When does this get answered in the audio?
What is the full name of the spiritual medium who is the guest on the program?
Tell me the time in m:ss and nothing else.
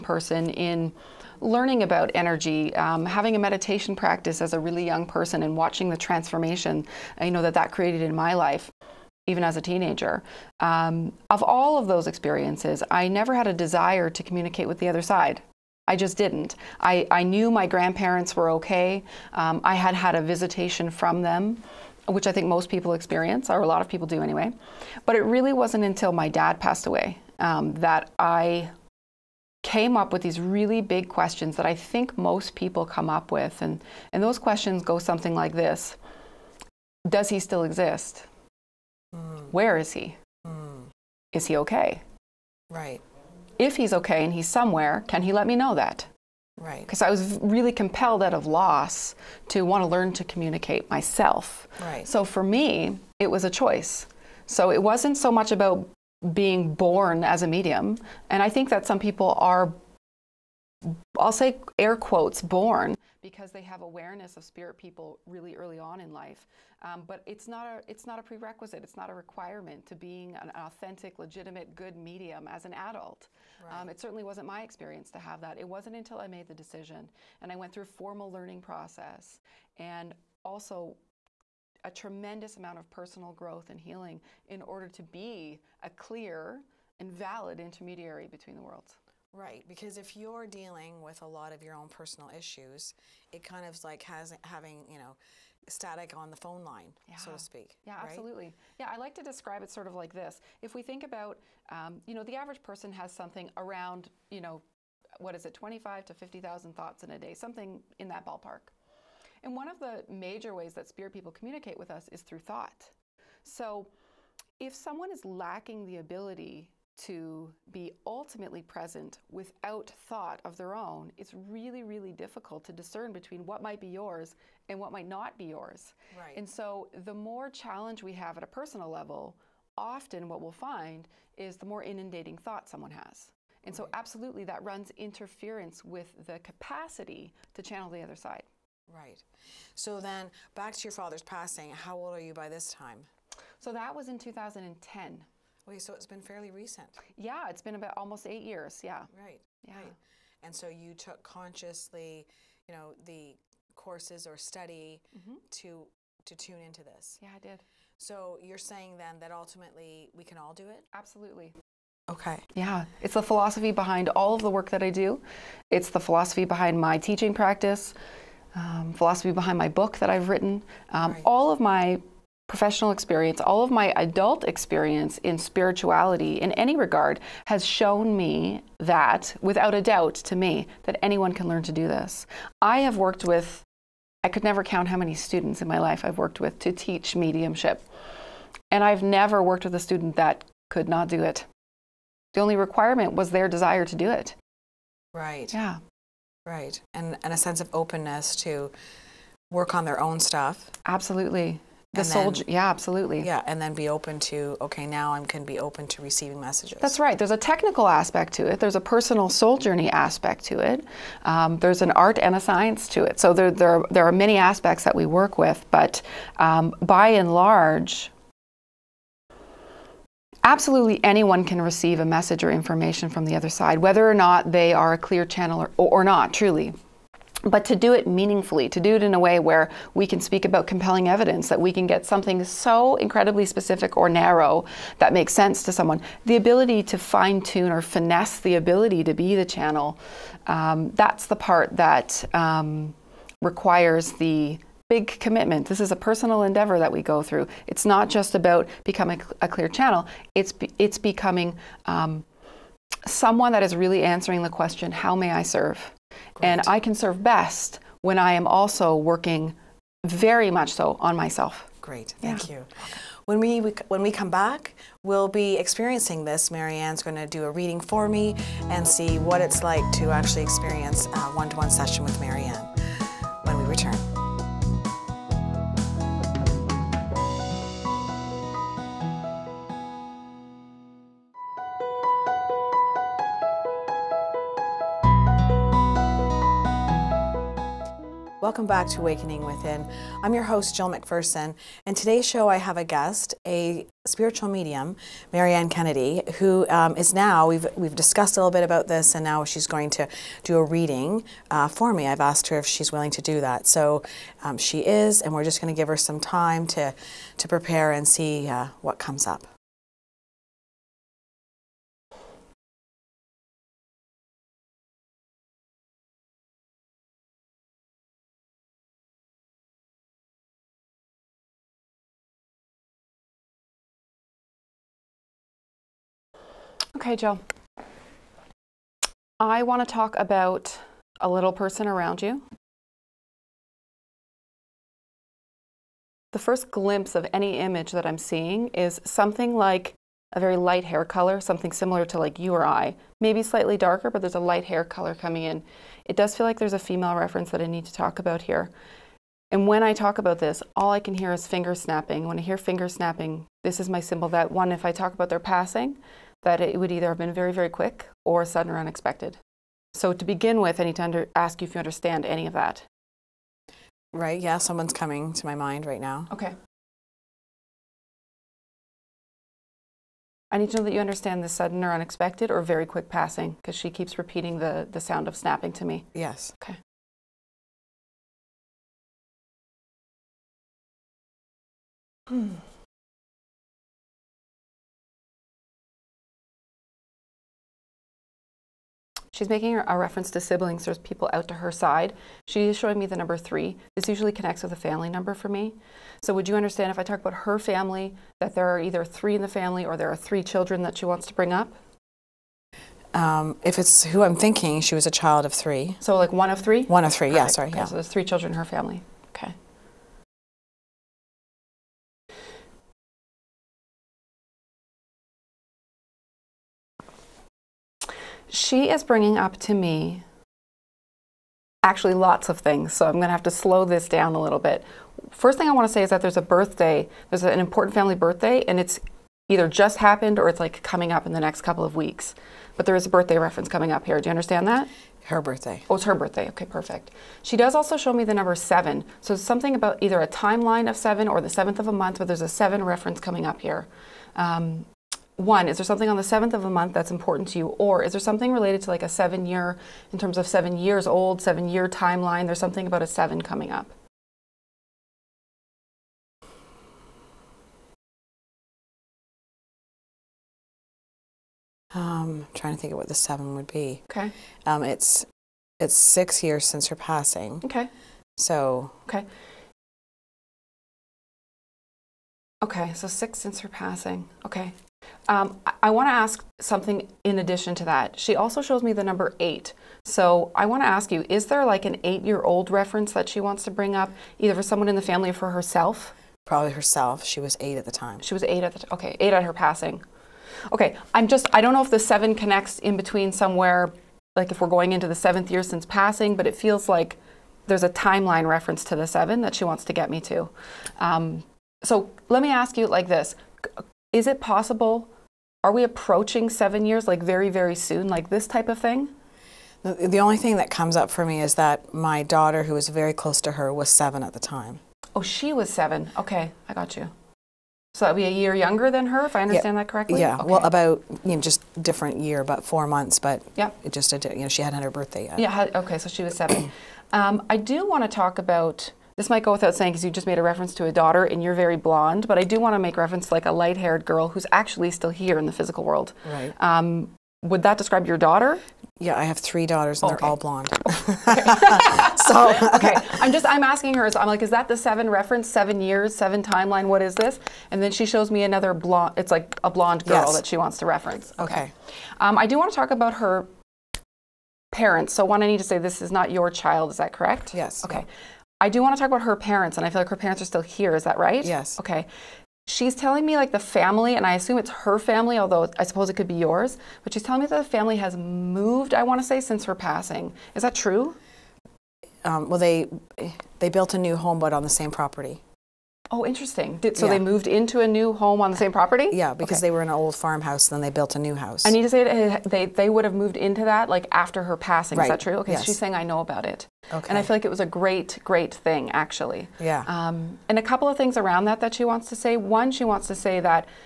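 4:55.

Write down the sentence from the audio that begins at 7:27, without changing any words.
Or is there something related to like a seven year, in terms of seven years old, seven year timeline?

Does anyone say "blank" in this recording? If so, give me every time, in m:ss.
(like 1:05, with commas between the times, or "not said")
not said.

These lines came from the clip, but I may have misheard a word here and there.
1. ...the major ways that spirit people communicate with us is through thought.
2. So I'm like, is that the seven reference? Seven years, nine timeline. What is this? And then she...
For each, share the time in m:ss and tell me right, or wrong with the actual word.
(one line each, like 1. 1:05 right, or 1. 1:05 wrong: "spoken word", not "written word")
1. 1:49 right
2. 9:04 wrong: "seven", not "nine".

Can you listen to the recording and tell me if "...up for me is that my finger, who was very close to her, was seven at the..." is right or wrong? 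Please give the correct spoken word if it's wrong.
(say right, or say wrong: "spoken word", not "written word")
wrong: "daughter", not "finger".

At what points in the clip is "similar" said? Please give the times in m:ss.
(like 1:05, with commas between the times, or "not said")
5:41.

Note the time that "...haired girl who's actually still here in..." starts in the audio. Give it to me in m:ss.
8:53.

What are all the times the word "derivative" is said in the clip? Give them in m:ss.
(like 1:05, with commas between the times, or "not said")
not said.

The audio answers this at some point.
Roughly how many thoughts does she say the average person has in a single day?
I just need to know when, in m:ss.
1:45.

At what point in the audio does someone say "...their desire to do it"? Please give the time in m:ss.
3:13.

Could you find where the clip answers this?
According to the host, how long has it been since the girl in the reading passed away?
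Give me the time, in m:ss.
7:45.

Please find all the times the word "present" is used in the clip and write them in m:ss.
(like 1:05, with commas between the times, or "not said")
1:58.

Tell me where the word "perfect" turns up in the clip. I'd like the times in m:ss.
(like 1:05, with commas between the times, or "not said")
6:47, 7:16.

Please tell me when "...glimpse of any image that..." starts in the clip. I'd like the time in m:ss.
5:36.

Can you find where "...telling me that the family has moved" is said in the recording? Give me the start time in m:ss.
9:27.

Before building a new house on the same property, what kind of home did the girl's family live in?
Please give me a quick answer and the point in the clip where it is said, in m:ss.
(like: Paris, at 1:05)
old farmhouse, at 9:39.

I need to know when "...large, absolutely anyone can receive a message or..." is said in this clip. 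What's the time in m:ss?
3:37.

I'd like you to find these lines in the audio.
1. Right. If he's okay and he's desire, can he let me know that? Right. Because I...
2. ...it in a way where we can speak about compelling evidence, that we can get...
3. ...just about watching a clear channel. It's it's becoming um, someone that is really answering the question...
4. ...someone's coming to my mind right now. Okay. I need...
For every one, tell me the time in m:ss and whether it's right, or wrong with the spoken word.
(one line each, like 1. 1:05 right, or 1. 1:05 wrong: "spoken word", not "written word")
1. 0:42 wrong: "somewhere", not "desire"
2. 3:48 right
3. 4:08 wrong: "becoming", not "watching"
4. 6:04 right.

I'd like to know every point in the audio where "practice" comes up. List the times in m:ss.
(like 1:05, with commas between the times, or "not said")
0:03, 2:47.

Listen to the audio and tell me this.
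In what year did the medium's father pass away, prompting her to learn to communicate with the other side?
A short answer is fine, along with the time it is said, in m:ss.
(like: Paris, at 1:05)
2010, at 2:24.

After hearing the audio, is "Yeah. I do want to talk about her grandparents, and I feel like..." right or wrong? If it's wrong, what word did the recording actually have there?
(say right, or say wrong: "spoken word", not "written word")
wrong: "parents", not "grandparents".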